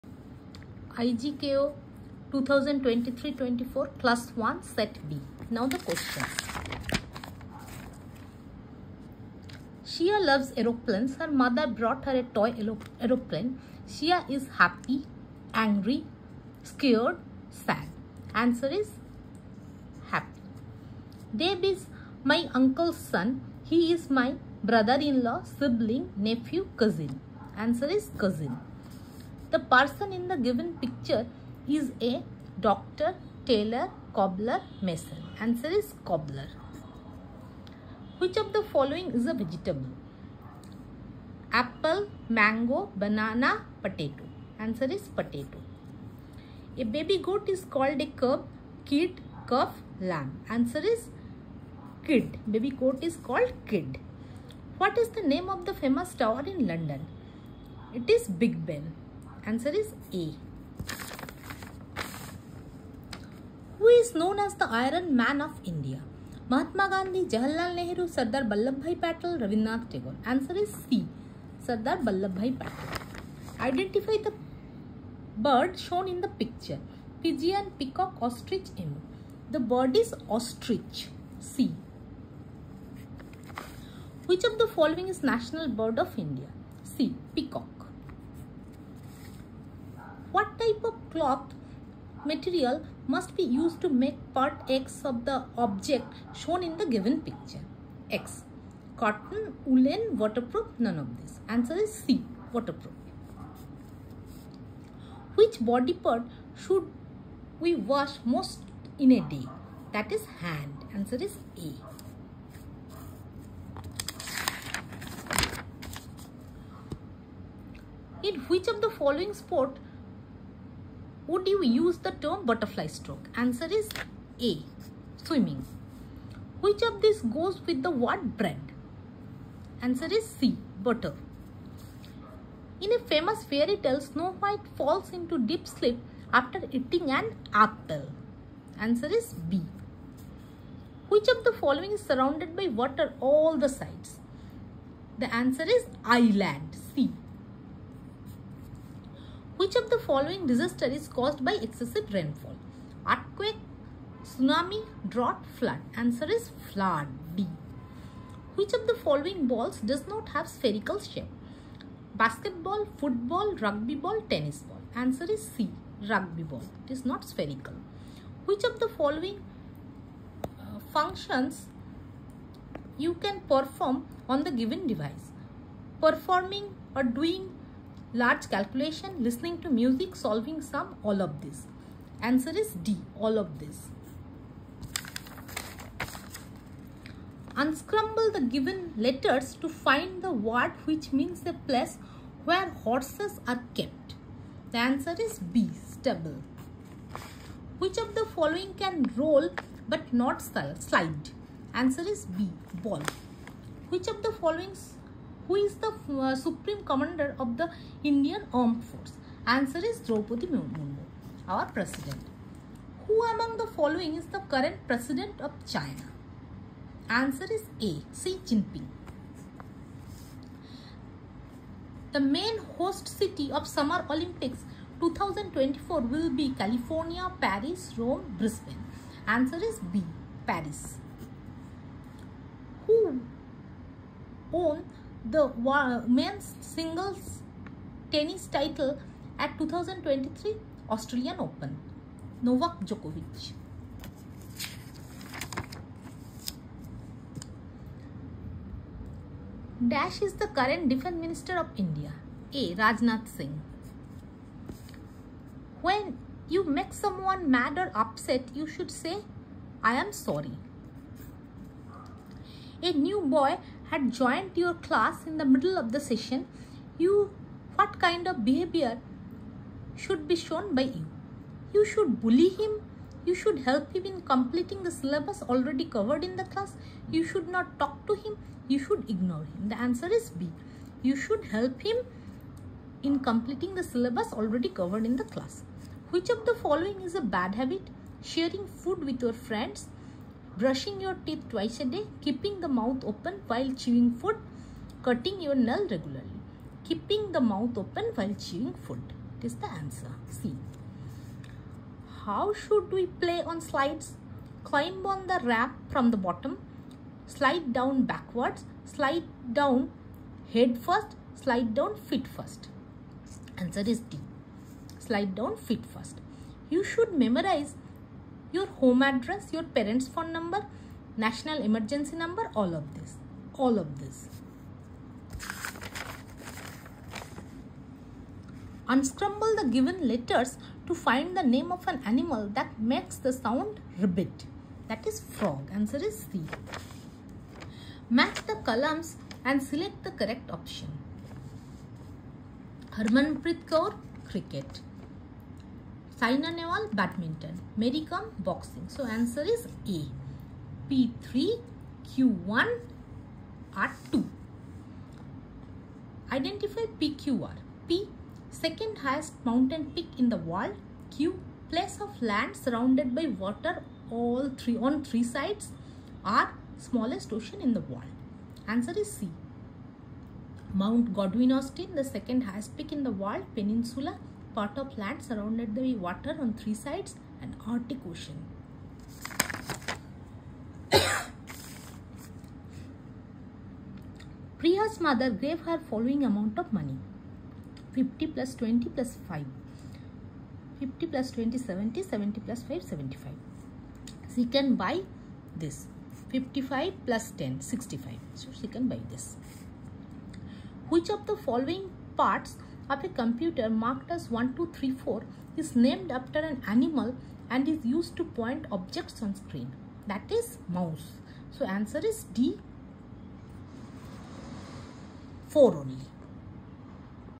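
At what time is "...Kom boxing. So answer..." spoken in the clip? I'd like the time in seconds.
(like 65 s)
348 s.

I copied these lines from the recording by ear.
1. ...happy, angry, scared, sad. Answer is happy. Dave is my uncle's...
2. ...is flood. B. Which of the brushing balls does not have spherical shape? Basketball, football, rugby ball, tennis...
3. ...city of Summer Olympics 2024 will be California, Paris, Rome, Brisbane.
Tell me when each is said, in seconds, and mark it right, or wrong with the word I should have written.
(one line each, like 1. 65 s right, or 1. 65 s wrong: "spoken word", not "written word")
1. 14 s right
2. 156 s wrong: "following", not "brushing"
3. 223 s right.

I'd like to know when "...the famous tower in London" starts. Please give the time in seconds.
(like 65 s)
55 s.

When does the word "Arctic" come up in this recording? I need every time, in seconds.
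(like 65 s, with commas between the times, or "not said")
377 s.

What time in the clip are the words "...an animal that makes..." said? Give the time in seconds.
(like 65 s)
331 s.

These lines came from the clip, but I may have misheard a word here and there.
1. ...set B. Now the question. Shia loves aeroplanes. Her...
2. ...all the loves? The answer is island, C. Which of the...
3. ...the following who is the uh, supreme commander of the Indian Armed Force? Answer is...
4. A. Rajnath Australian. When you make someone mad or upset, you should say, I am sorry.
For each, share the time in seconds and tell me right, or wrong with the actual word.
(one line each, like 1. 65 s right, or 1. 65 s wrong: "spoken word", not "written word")
1. 4 s right
2. 143 s wrong: "sides", not "loves"
3. 204 s right
4. 252 s wrong: "Singh", not "Australian".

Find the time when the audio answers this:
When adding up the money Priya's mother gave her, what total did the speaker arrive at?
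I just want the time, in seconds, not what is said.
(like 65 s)
392 s.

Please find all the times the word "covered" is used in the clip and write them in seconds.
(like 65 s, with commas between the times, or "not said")
275 s, 284 s.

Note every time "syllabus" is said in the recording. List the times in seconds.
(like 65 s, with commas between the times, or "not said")
274 s, 283 s.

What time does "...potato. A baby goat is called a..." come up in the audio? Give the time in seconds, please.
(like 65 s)
45 s.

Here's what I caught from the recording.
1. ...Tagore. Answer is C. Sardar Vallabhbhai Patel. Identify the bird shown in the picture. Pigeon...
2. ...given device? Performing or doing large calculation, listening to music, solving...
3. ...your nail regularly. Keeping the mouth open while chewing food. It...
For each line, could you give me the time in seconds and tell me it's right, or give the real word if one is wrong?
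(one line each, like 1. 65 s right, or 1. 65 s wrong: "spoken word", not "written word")
1. 69 s right
2. 174 s right
3. 295 s right.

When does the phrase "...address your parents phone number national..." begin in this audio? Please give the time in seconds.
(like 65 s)
319 s.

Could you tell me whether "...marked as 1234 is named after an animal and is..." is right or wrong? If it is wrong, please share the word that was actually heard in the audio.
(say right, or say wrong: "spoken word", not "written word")
right.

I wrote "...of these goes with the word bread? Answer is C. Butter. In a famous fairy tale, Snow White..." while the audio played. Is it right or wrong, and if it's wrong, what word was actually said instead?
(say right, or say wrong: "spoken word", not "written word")
right.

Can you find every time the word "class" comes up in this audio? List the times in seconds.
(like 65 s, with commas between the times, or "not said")
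264 s, 276 s, 285 s.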